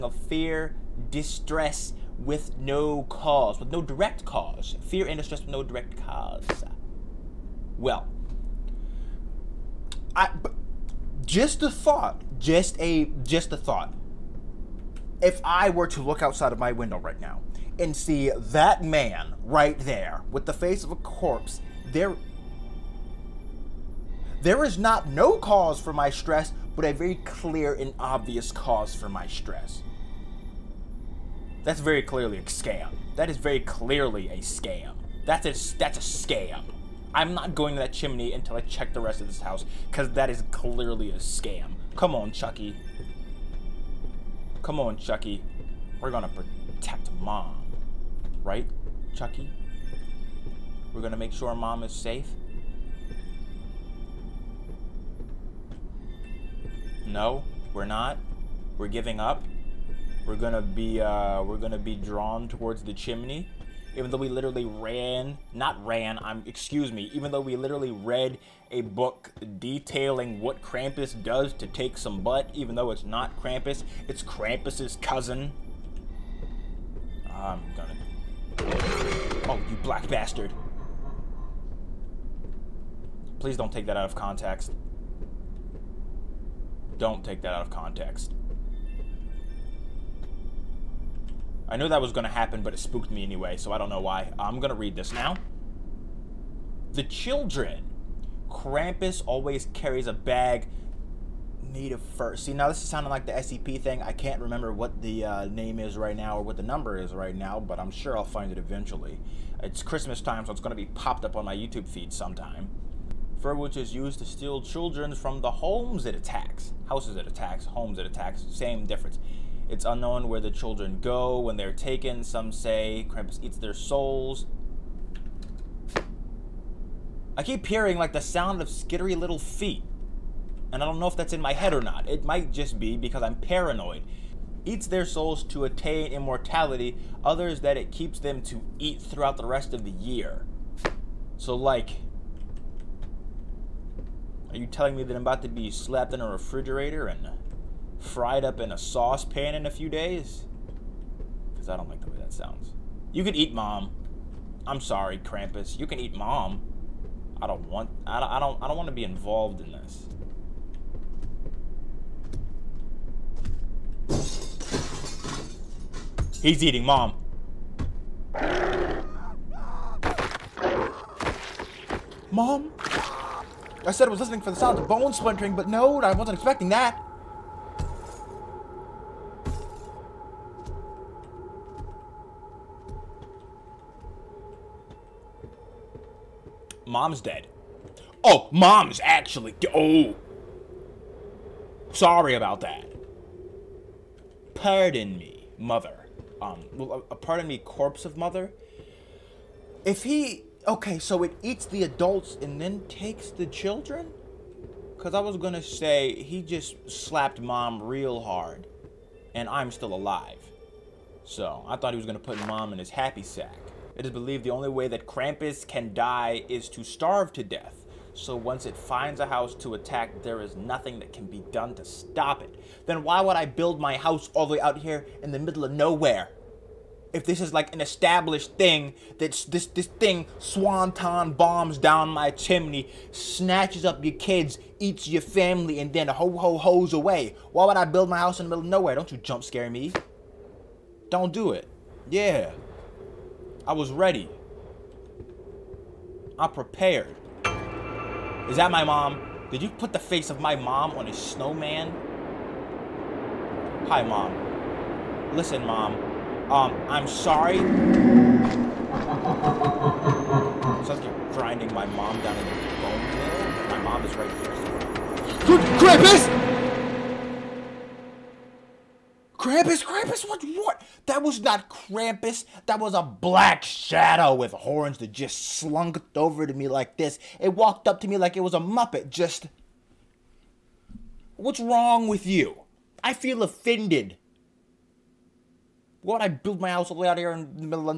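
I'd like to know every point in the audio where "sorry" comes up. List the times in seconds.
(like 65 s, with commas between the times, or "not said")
154 s, 191 s, 257 s.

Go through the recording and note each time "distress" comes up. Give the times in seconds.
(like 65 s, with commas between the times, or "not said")
1 s, 5 s.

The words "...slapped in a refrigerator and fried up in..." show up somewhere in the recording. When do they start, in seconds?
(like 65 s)
145 s.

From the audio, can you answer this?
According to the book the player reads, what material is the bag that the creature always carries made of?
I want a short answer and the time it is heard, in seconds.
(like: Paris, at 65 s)
Fur, at 101 s.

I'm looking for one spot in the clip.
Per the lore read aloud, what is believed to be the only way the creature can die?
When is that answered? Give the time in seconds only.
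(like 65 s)
216 s.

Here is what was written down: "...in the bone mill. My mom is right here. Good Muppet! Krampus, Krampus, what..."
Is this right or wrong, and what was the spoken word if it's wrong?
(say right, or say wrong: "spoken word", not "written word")
wrong: "Krampus", not "Muppet".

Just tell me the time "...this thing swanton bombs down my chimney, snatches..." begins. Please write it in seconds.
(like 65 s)
229 s.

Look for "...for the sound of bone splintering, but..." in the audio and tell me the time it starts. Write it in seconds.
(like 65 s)
174 s.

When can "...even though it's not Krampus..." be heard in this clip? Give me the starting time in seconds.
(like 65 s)
72 s.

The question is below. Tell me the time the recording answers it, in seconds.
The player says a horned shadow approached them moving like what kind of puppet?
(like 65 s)
278 s.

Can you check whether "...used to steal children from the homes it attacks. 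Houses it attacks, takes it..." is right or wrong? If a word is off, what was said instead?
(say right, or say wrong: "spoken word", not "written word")
wrong: "homes", not "takes".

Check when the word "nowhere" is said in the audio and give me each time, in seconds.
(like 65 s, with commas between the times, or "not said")
225 s, 238 s.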